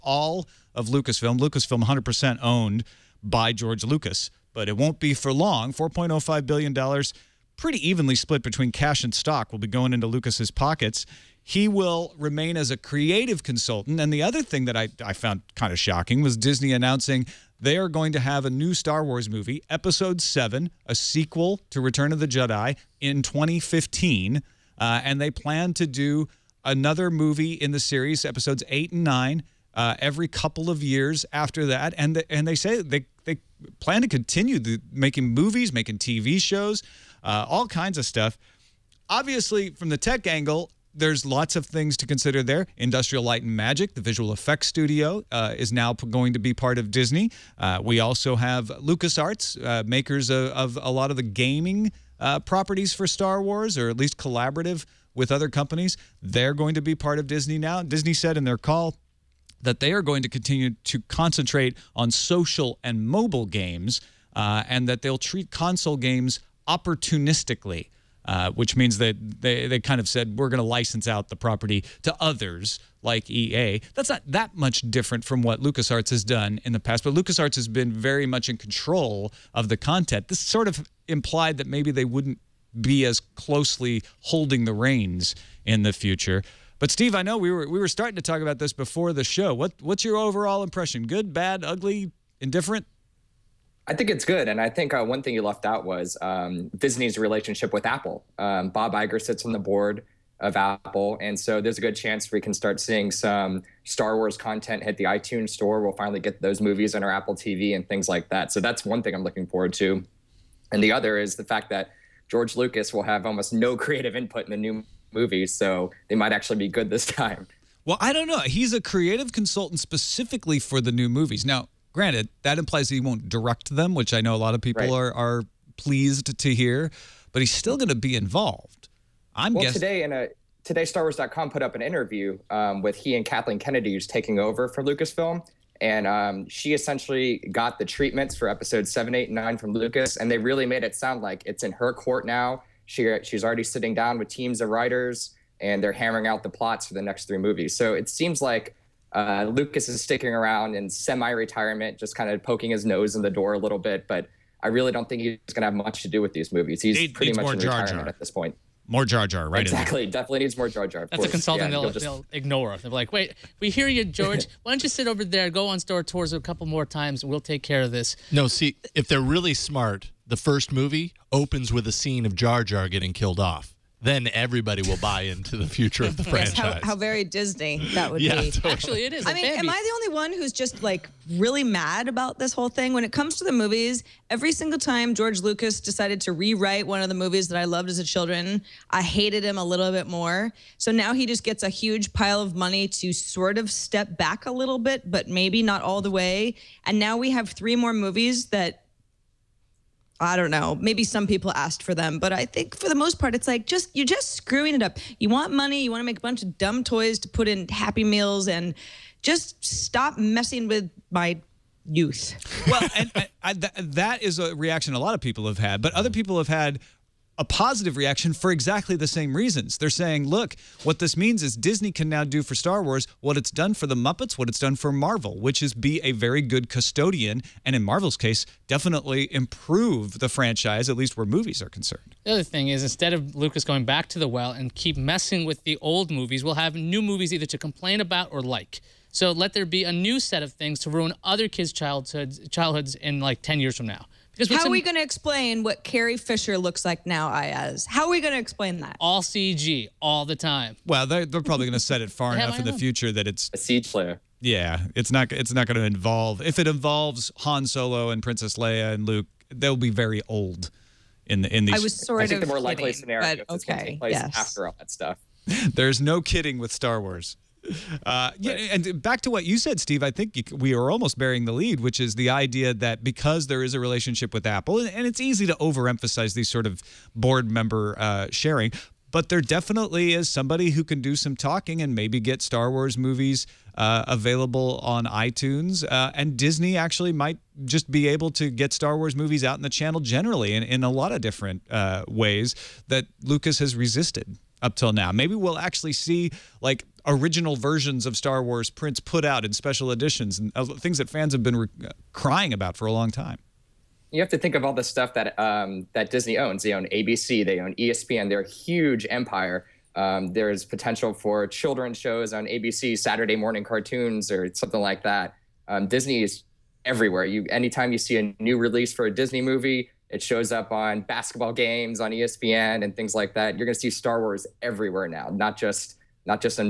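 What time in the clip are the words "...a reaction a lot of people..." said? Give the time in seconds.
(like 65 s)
214 s.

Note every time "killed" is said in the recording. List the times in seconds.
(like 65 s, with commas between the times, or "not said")
173 s.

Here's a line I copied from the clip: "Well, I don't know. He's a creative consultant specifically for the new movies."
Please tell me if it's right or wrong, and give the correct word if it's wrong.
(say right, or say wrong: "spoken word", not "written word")
right.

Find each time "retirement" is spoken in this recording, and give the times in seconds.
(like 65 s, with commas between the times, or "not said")
150 s, 157 s.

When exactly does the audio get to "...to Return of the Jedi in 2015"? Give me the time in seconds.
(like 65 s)
21 s.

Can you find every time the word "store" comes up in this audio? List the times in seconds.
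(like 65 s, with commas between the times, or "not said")
105 s, 165 s.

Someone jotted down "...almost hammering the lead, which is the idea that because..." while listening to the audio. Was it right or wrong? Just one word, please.
wrong.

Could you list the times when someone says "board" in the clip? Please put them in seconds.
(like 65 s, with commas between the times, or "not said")
99 s, 277 s.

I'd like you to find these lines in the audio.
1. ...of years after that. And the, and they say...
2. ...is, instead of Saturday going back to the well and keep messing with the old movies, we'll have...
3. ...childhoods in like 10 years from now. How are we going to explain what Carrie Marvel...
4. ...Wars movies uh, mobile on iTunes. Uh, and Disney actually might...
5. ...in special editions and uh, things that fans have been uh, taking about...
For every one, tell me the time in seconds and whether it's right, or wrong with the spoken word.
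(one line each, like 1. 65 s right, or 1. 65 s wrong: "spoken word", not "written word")
1. 30 s right
2. 232 s wrong: "Lucas", not "Saturday"
3. 242 s wrong: "Fisher", not "Marvel"
4. 282 s wrong: "available", not "mobile"
5. 299 s wrong: "crying", not "taking".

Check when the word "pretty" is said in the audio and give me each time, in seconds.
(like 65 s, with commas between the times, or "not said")
7 s, 157 s.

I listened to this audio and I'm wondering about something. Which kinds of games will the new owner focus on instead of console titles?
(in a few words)
Social and mobile games.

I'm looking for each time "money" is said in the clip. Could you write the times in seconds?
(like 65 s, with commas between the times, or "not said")
192 s, 205 s.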